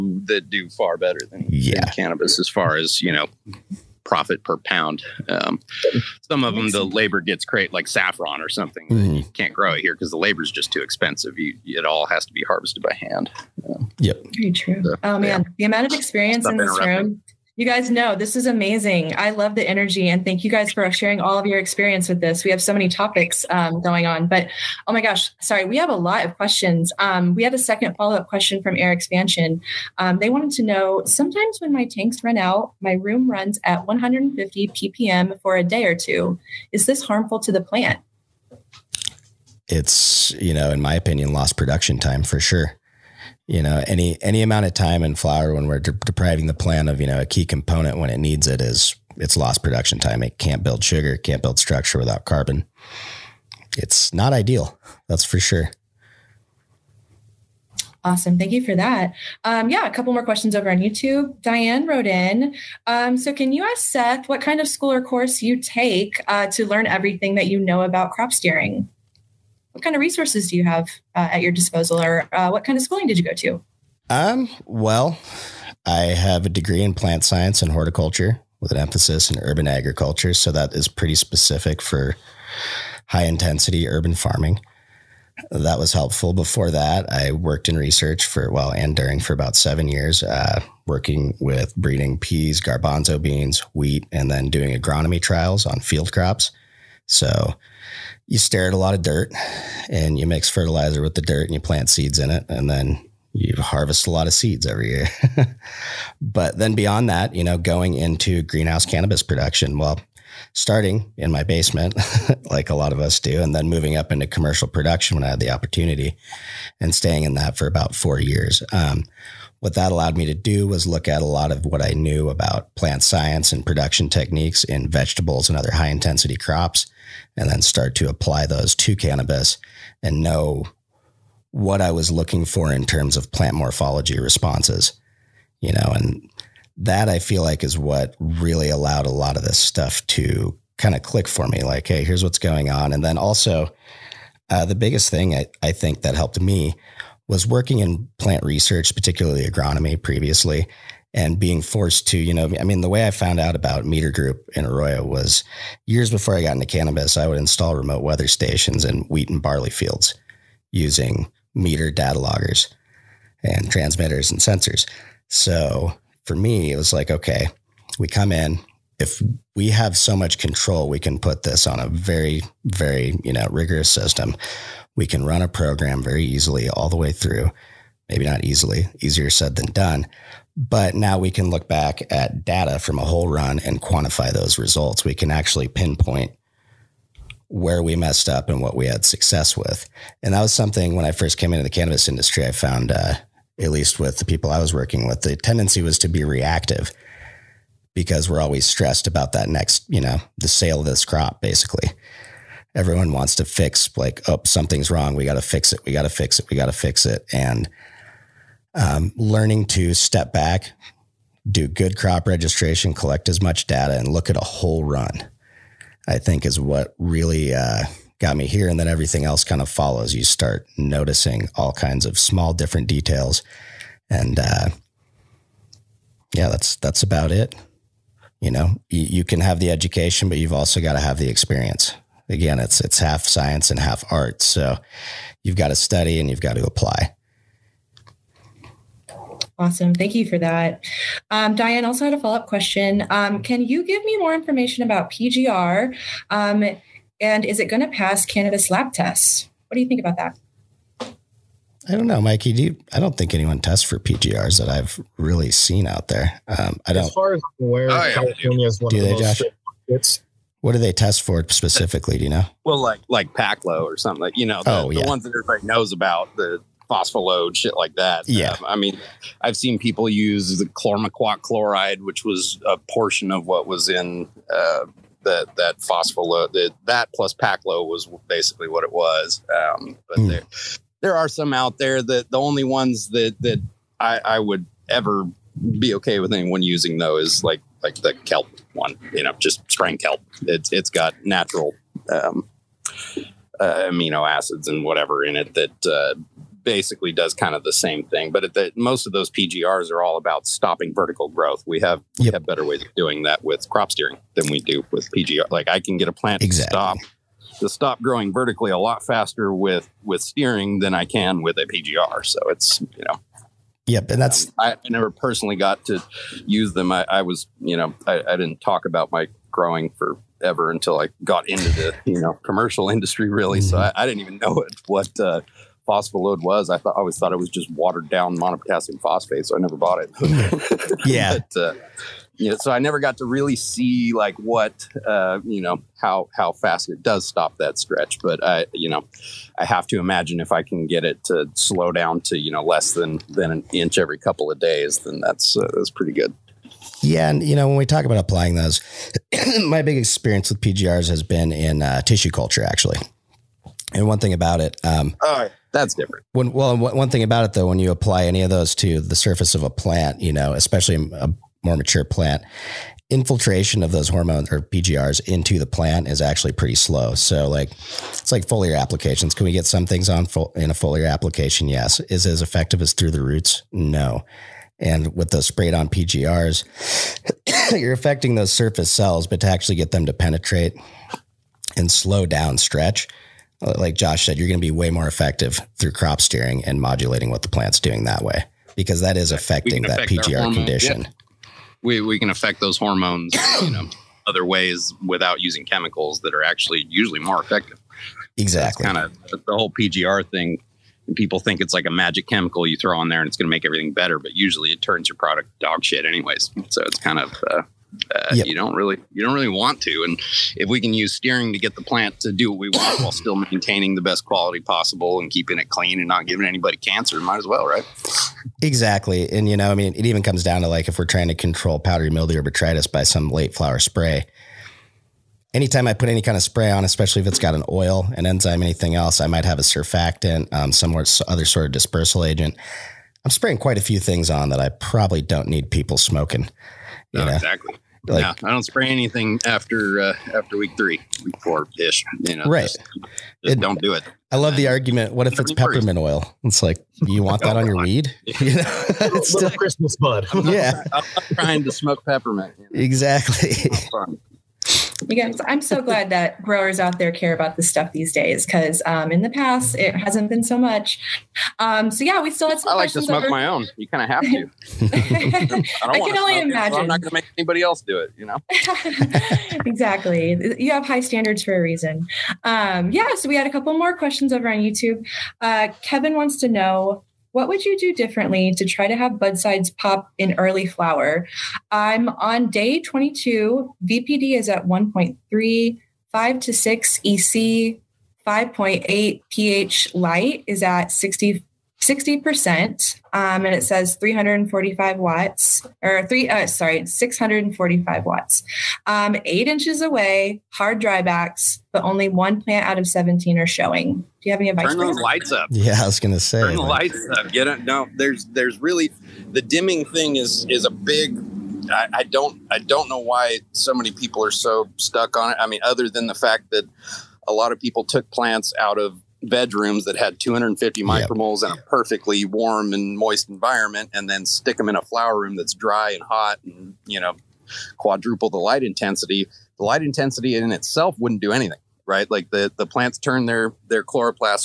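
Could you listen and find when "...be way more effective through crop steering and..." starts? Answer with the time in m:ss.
6:24.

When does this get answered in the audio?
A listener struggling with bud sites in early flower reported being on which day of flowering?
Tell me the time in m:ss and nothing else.
8:02.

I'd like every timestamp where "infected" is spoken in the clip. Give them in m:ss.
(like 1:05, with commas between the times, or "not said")
not said.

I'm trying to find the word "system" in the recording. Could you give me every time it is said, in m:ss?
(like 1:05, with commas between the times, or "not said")
2:53.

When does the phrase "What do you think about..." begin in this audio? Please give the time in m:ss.
4:09.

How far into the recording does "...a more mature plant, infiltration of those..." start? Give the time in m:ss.
6:00.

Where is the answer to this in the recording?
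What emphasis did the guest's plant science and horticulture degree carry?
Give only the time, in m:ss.
1:19.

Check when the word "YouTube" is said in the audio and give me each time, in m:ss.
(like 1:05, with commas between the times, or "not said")
1:00, 7:54.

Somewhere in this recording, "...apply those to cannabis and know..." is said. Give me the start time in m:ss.
2:08.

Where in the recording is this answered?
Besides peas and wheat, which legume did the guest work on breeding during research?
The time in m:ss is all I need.
1:32.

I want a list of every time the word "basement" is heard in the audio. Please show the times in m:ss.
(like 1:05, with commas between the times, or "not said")
1:51.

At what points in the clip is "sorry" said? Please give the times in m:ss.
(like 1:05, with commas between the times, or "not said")
0:25, 8:16.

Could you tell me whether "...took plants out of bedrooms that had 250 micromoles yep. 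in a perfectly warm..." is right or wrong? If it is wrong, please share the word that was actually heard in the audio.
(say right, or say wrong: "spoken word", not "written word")
right.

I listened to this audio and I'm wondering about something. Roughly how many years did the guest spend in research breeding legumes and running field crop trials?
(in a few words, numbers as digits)
seven years.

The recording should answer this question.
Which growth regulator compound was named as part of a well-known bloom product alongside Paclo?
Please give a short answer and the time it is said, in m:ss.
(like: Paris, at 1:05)
chlormequat chloride, at 4:30.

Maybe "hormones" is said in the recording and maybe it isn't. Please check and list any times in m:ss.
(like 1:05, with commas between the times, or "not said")
6:04, 6:32.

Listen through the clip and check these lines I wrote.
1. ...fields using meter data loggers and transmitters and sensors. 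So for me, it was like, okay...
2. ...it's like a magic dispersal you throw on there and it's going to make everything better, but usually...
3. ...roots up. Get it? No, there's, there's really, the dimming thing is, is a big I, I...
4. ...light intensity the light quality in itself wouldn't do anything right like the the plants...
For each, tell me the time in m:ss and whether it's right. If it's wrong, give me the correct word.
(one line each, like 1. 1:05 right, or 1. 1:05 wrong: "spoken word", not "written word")
1. 2:39 right
2. 6:41 wrong: "chemical", not "dispersal"
3. 8:26 wrong: "lights", not "roots"
4. 8:48 wrong: "intensity", not "quality".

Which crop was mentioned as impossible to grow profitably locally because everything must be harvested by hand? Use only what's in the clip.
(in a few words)
saffron.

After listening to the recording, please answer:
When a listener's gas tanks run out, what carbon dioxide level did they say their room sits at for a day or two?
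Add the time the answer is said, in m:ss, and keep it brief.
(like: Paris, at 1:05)
150 ppm, at 0:33.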